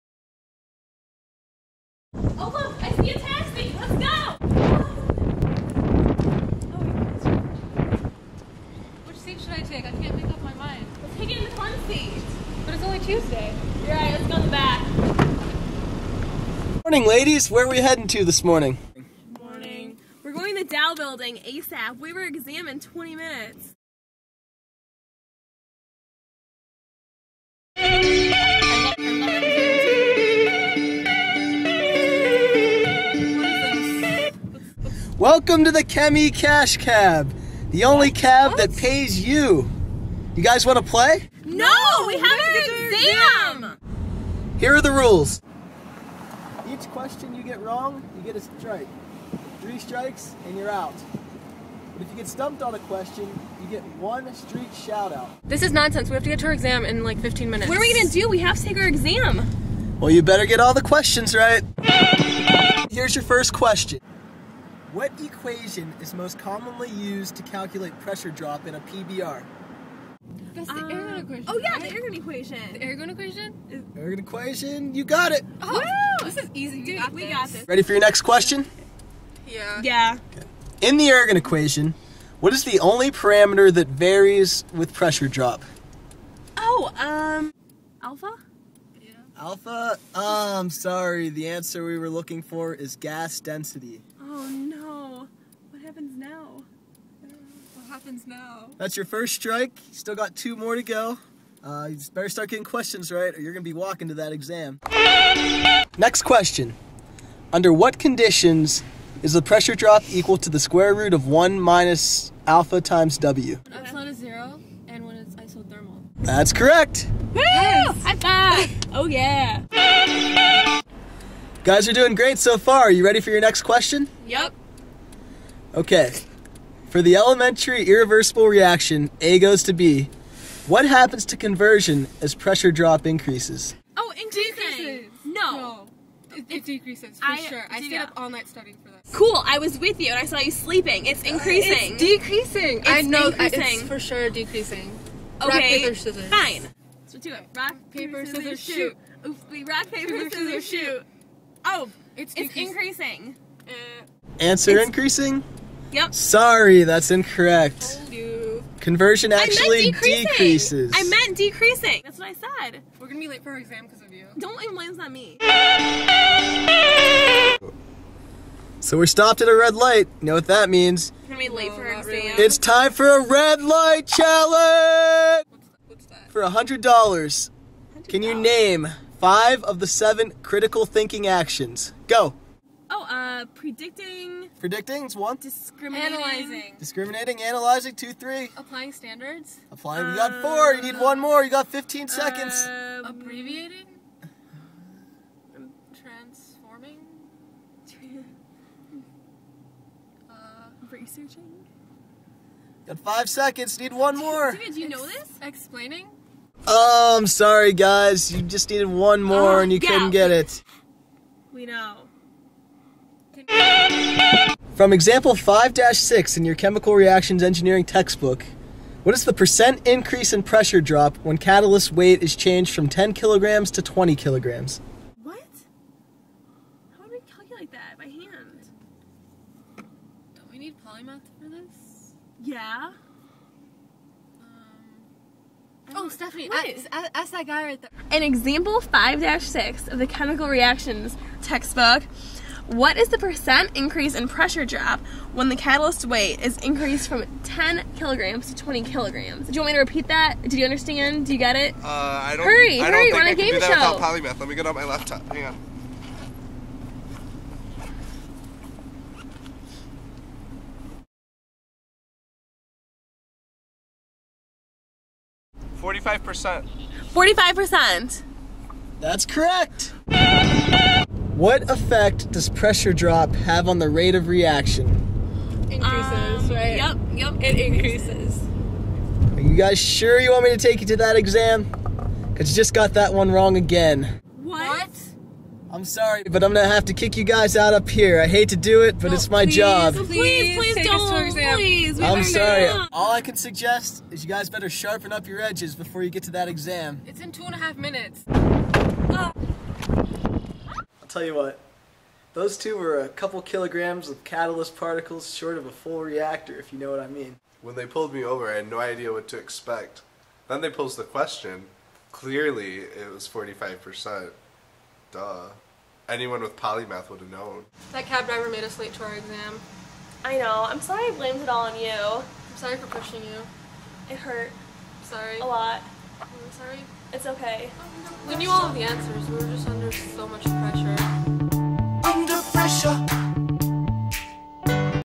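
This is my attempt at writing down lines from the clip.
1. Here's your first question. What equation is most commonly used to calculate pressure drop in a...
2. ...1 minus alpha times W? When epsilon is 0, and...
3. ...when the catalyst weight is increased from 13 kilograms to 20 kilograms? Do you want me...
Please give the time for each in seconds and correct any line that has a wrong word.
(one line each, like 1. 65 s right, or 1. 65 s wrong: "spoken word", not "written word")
1. 62 s right
2. 111 s right
3. 245 s wrong: "10", not "13".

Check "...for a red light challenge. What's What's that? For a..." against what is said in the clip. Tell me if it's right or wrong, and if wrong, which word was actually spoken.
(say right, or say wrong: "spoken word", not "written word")
right.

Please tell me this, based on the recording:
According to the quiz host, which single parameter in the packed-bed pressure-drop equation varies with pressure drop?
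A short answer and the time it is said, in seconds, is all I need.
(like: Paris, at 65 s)
gas density, at 92 s.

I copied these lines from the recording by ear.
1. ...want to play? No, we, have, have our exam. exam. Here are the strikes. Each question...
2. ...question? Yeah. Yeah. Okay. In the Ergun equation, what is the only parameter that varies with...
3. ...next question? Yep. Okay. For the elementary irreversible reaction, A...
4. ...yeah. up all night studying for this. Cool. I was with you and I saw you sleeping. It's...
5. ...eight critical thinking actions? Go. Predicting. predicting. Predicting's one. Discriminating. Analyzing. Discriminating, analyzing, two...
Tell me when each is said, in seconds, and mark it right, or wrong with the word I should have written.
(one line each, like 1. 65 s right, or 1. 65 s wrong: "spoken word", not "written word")
1. 40 s wrong: "rules", not "strikes"
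2. 78 s right
3. 123 s right
4. 137 s right
5. 179 s wrong: "seven", not "eight".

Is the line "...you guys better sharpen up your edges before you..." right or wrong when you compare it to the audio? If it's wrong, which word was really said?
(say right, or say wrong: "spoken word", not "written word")
right.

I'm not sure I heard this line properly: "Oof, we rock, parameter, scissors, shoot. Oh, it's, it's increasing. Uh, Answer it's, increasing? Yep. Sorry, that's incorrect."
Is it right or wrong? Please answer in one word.
wrong.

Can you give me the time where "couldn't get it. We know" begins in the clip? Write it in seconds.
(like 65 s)
209 s.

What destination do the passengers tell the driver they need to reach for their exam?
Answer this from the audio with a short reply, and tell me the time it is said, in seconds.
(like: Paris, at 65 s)
Dow building, at 20 s.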